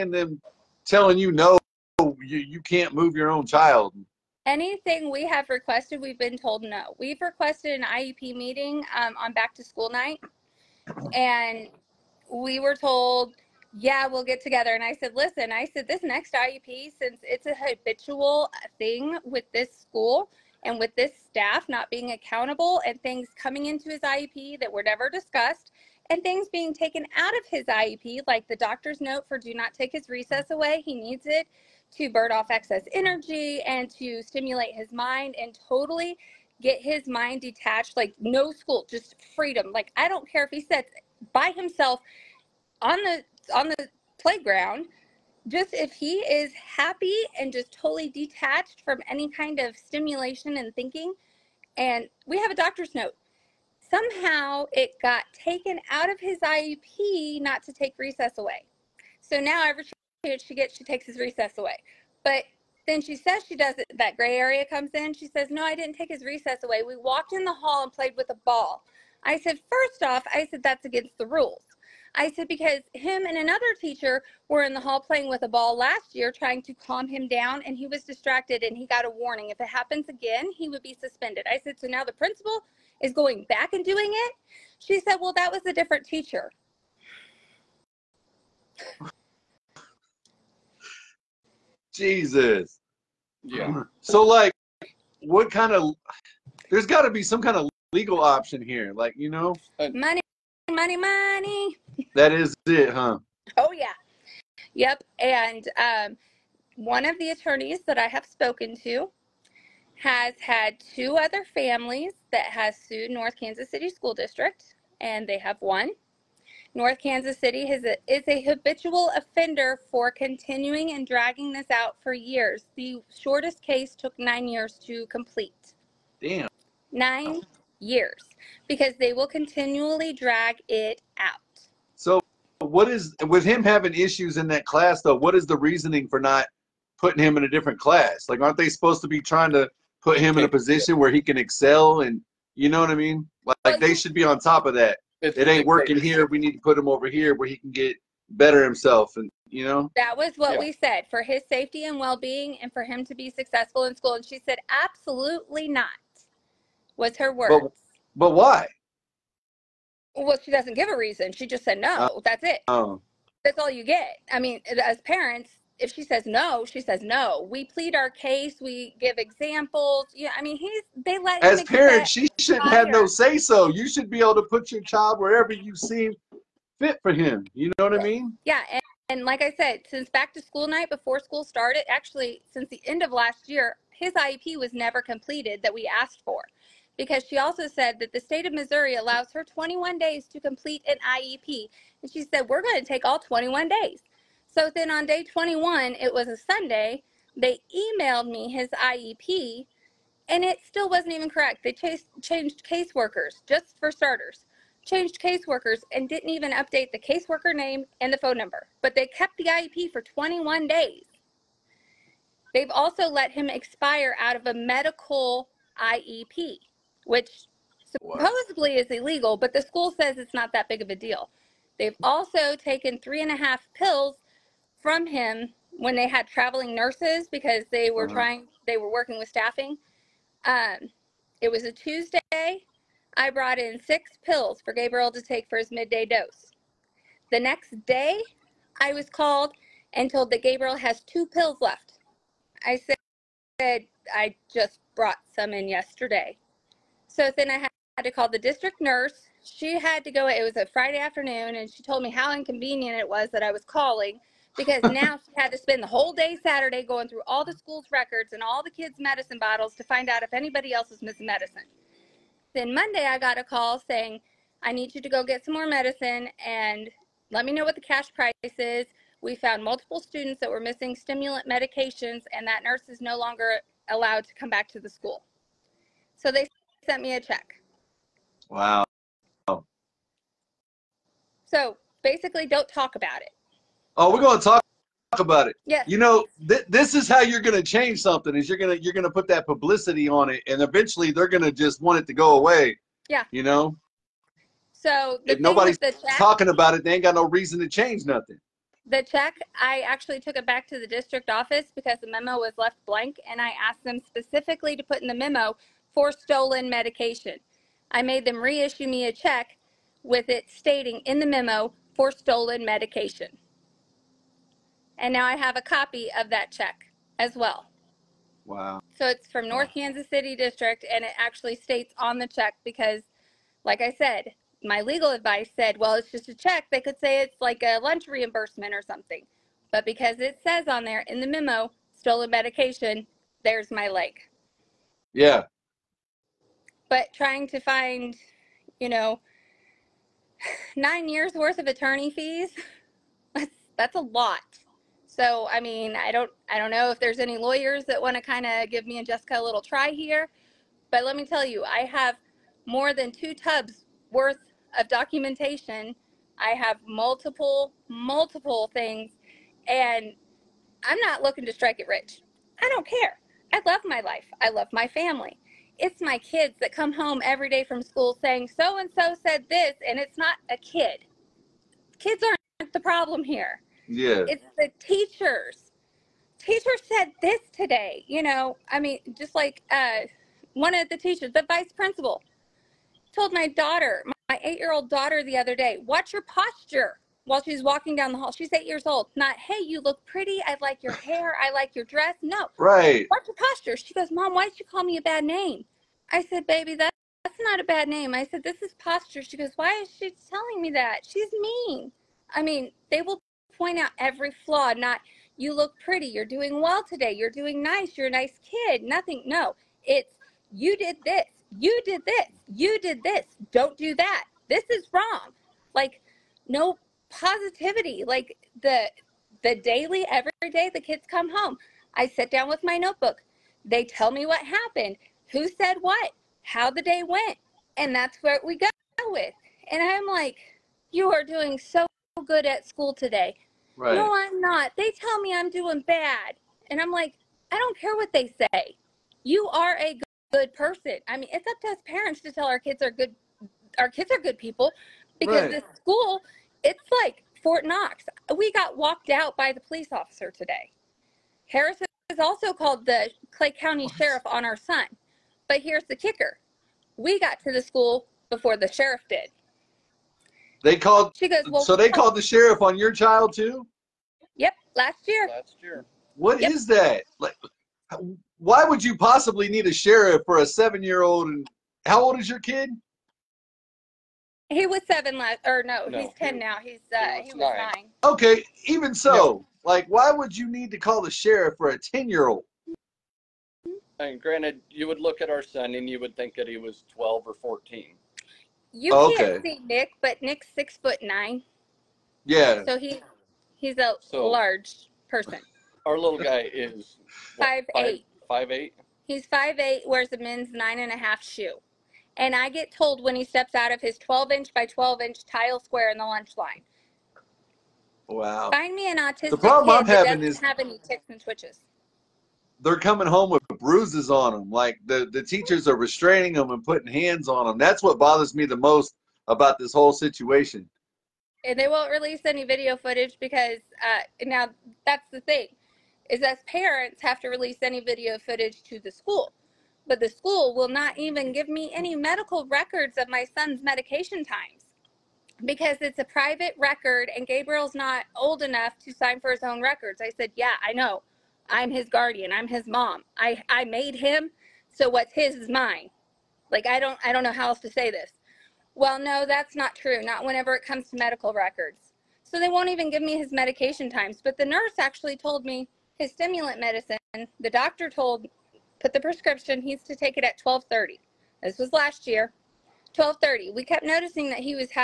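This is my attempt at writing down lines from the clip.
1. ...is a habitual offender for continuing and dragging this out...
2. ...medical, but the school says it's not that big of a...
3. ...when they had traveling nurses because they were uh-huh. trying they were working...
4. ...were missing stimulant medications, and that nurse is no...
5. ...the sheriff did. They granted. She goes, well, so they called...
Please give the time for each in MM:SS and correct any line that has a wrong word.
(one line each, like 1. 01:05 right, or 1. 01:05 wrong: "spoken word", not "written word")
1. 01:58 right
2. 03:38 wrong: "illegal", not "medical"
3. 03:45 right
4. 04:30 right
5. 07:38 wrong: "called", not "granted".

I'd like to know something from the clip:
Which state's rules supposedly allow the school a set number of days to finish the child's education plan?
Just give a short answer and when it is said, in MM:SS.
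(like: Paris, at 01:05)
Missouri, at 03:08.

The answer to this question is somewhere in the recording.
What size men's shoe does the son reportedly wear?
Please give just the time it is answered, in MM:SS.
08:20.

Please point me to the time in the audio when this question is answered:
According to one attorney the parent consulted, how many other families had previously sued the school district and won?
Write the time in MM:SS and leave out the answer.
01:50.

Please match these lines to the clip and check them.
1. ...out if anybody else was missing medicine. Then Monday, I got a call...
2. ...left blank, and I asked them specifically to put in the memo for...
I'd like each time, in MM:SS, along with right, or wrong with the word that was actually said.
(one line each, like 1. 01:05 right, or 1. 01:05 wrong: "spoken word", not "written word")
1. 04:20 right
2. 05:02 right.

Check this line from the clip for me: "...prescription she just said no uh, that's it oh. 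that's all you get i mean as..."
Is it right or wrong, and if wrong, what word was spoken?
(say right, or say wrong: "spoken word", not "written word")
wrong: "reason", not "prescription".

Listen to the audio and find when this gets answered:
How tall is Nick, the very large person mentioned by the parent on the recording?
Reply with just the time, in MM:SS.
08:10.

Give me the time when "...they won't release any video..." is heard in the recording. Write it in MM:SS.
08:41.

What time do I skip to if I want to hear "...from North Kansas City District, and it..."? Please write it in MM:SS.
05:19.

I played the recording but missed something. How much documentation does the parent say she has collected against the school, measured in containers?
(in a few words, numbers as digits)
More than two tubs.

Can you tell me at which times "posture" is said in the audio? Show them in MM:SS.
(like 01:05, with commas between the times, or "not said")
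06:26, 06:33, 06:38.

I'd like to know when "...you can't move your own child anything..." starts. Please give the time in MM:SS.
00:02.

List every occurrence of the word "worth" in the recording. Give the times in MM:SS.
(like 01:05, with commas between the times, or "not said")
05:41, 05:54.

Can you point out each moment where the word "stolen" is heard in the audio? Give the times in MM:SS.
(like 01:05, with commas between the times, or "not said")
05:06, 05:12, 05:31.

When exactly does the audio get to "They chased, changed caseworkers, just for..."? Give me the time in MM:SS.
03:21.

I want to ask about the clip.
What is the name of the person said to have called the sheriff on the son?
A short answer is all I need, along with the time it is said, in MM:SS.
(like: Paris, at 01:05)
Harris, at 07:31.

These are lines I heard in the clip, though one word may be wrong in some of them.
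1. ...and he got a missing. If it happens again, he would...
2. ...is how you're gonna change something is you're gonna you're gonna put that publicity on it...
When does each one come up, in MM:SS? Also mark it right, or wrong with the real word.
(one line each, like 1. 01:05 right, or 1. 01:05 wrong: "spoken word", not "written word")
1. 01:18 wrong: "warning", not "missing"
2. 04:46 right.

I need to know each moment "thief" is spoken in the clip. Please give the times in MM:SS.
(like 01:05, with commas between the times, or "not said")
not said.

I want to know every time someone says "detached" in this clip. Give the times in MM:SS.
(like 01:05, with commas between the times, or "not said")
00:37, 00:48.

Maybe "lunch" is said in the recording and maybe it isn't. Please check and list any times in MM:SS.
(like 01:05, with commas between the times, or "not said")
05:27, 08:26.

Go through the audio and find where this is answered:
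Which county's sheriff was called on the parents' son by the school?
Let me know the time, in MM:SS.
07:33.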